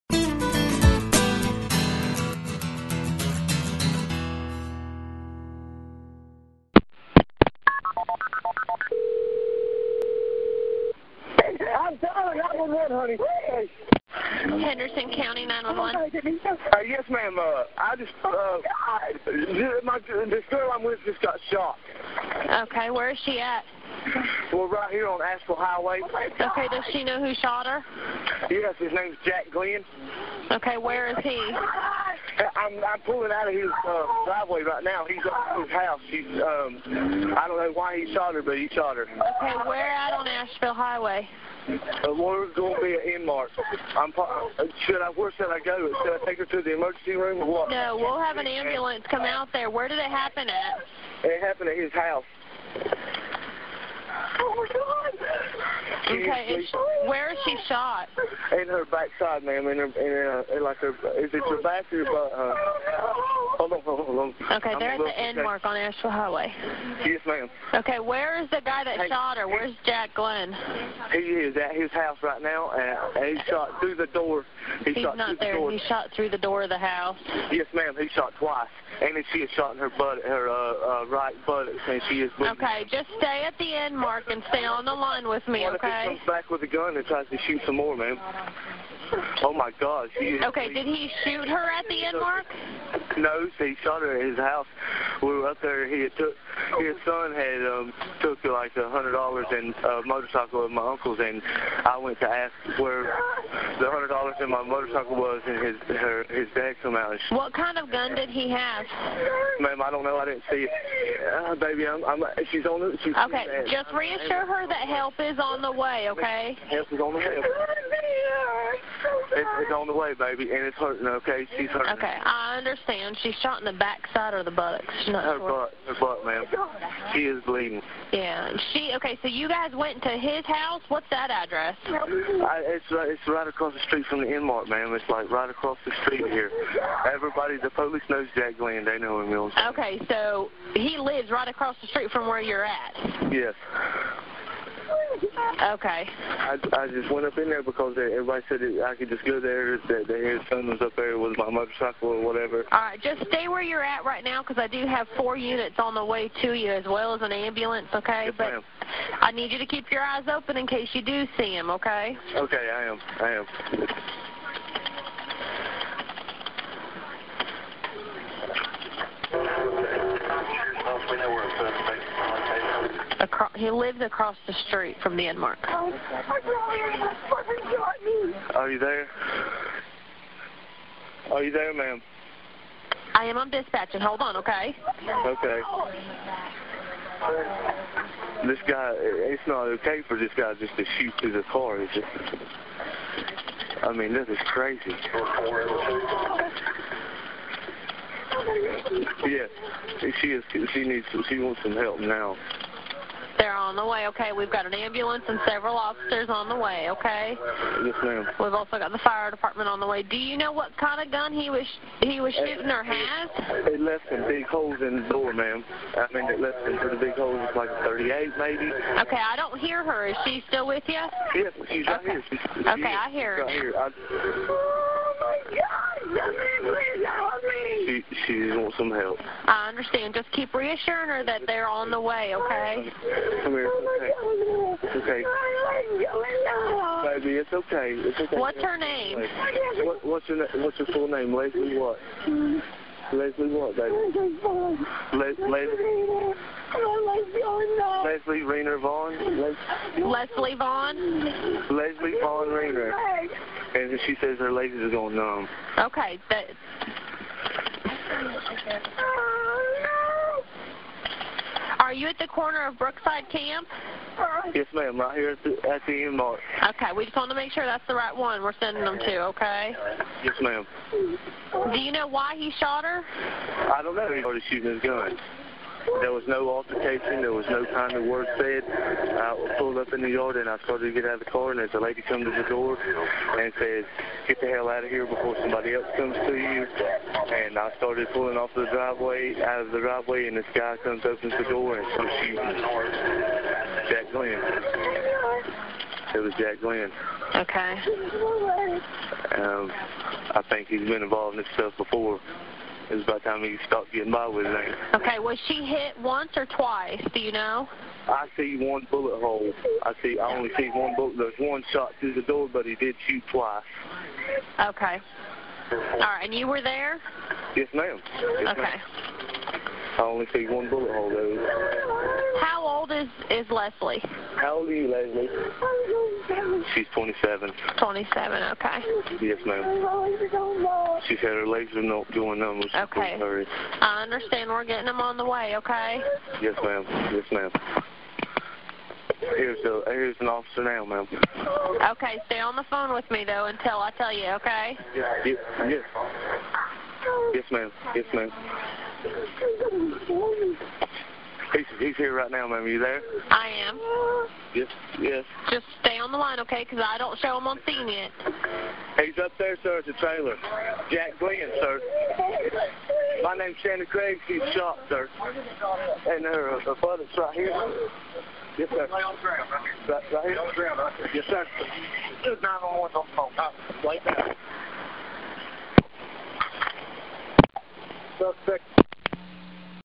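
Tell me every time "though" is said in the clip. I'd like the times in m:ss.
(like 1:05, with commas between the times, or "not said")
5:21, 5:43.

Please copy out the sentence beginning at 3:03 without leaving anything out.
I am on dispatch, and hold on, okay?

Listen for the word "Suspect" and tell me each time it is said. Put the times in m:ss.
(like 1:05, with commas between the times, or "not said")
6:18.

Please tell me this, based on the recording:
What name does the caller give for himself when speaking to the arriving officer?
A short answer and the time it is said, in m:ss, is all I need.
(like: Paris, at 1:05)
Shannon Craig, at 6:03.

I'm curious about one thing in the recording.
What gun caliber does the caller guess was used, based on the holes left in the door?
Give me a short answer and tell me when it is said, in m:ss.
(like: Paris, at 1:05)
38, at 3:37.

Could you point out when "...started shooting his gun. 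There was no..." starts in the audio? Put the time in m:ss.
4:34.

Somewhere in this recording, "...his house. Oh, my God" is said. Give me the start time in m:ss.
0:51.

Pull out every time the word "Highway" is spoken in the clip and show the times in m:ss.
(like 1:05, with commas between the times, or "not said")
0:25, 0:40, 1:06.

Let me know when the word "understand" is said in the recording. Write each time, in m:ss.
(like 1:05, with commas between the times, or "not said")
2:02, 3:49, 5:34.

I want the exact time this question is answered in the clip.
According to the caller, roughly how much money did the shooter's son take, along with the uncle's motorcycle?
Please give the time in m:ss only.
1:38.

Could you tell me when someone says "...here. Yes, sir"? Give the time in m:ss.
6:07.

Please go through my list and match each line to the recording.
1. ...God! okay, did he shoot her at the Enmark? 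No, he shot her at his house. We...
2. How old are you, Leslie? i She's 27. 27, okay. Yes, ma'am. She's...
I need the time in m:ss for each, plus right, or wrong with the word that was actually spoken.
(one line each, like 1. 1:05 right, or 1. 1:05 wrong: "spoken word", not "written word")
1. 1:29 right
2. 5:24 right.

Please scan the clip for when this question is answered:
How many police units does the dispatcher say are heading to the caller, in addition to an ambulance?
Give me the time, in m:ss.
2:35.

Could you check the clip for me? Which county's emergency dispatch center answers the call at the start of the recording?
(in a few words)
Henderson County.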